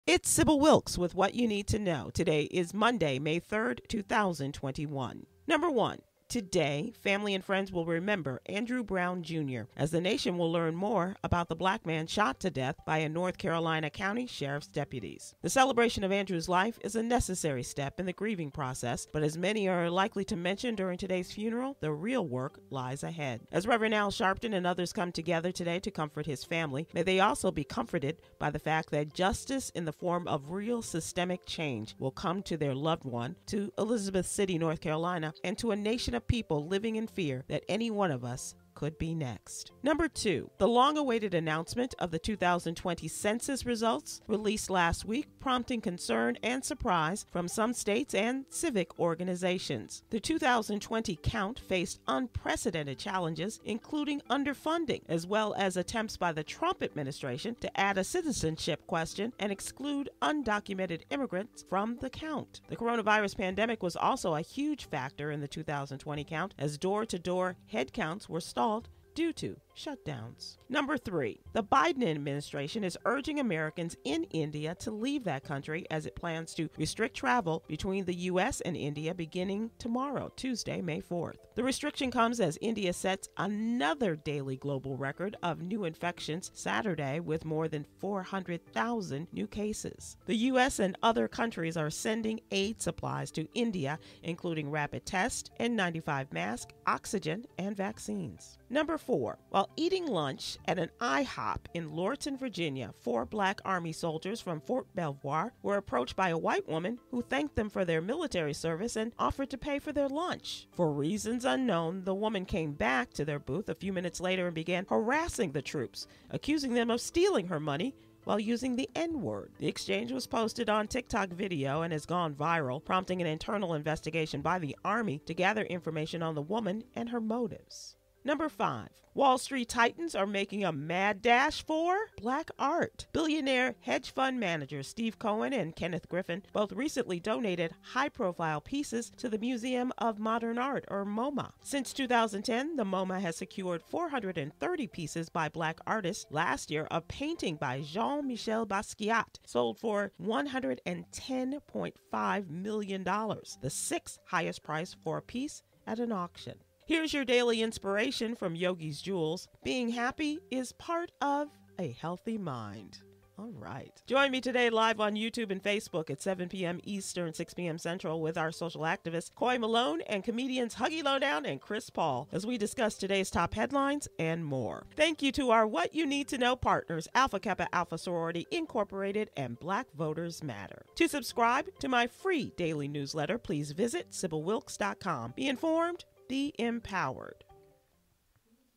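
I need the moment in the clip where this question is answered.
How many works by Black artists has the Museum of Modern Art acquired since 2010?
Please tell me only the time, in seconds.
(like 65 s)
143 s.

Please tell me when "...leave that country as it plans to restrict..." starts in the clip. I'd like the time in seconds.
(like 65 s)
74 s.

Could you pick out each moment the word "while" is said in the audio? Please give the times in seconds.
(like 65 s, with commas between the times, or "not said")
99 s, 118 s.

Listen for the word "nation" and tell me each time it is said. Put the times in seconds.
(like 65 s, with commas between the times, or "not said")
9 s, 35 s.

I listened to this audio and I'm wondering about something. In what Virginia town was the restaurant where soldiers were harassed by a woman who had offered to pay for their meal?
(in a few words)
Lorton.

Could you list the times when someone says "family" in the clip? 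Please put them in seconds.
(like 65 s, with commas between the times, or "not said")
7 s, 26 s.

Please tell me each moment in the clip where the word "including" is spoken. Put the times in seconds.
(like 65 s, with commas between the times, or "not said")
53 s, 94 s.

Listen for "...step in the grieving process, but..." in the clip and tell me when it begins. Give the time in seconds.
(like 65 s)
17 s.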